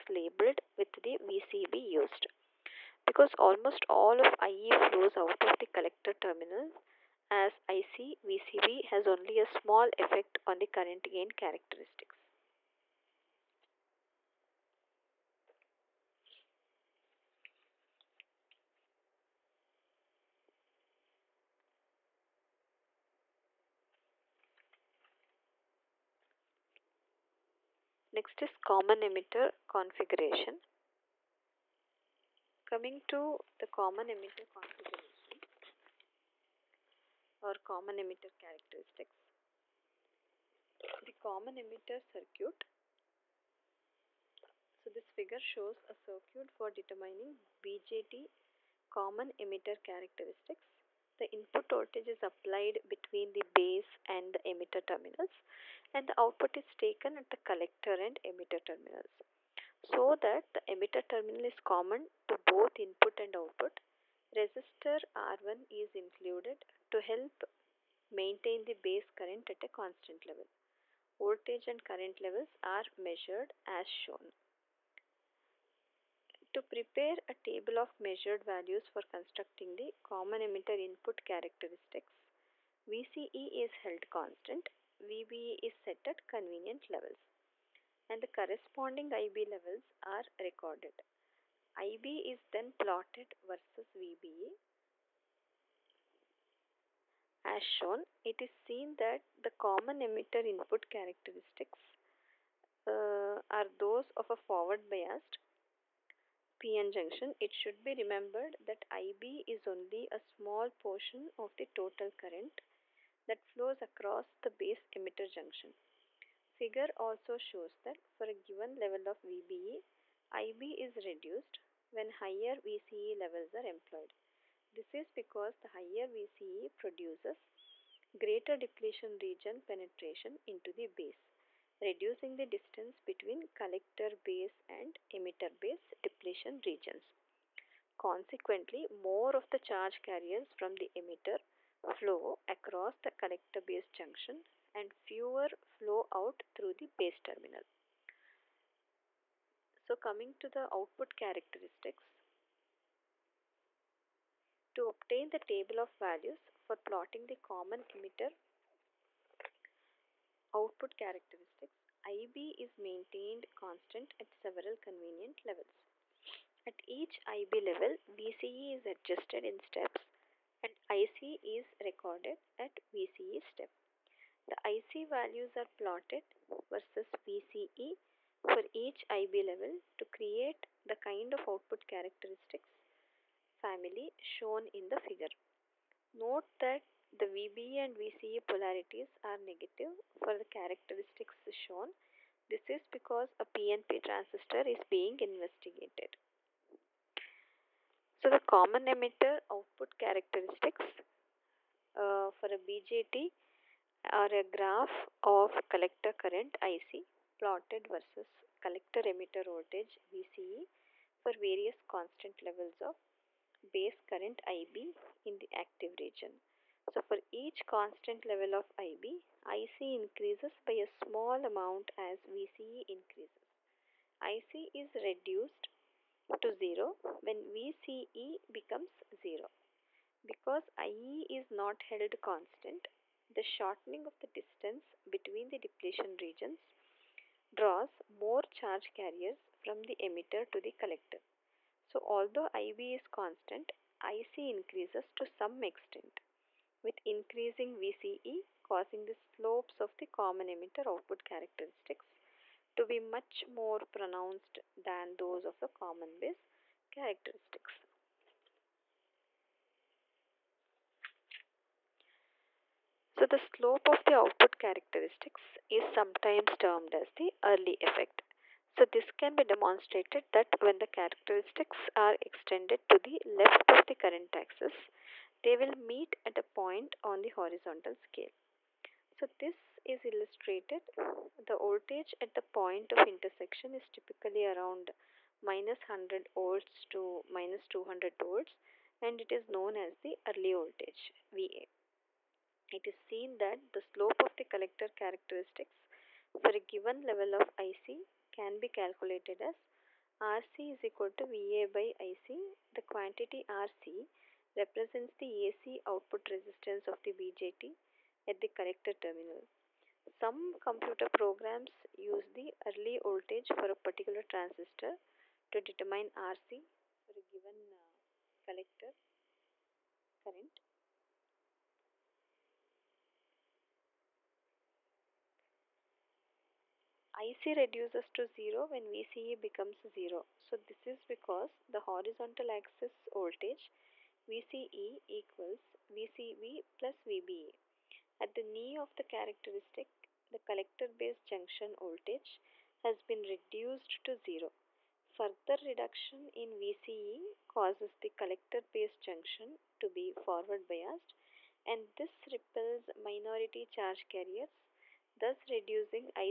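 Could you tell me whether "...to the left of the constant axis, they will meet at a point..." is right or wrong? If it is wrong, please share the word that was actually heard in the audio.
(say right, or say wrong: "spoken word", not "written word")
wrong: "current", not "constant".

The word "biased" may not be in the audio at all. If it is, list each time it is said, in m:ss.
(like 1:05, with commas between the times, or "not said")
1:44, 5:50.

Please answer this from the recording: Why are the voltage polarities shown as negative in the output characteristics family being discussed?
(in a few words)
A PNP transistor.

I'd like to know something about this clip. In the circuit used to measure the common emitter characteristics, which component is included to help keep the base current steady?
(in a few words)
R1.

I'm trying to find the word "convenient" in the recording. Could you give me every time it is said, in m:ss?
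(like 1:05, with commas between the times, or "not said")
1:26, 2:44.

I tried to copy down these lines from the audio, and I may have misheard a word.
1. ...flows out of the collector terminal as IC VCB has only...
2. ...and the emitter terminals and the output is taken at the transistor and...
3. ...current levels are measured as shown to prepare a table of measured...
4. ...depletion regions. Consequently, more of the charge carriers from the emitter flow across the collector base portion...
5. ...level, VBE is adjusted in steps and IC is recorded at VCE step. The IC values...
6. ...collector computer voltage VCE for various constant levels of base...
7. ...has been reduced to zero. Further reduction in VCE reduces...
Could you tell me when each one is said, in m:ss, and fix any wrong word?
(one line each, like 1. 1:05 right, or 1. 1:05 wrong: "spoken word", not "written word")
1. 0:04 right
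2. 0:54 wrong: "collector", not "transistor"
3. 1:11 right
4. 2:16 wrong: "junction", not "portion"
5. 2:47 wrong: "VCE", not "VBE"
6. 3:28 wrong: "emitter", not "computer"
7. 5:42 wrong: "causes", not "reduces".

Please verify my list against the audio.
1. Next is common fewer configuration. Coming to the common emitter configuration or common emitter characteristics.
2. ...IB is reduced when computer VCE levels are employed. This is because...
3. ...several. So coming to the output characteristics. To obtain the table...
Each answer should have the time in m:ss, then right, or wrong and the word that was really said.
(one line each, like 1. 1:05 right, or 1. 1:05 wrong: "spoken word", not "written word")
1. 0:28 wrong: "emitter", not "fewer"
2. 2:00 wrong: "higher", not "computer"
3. 2:27 wrong: "terminal", not "several".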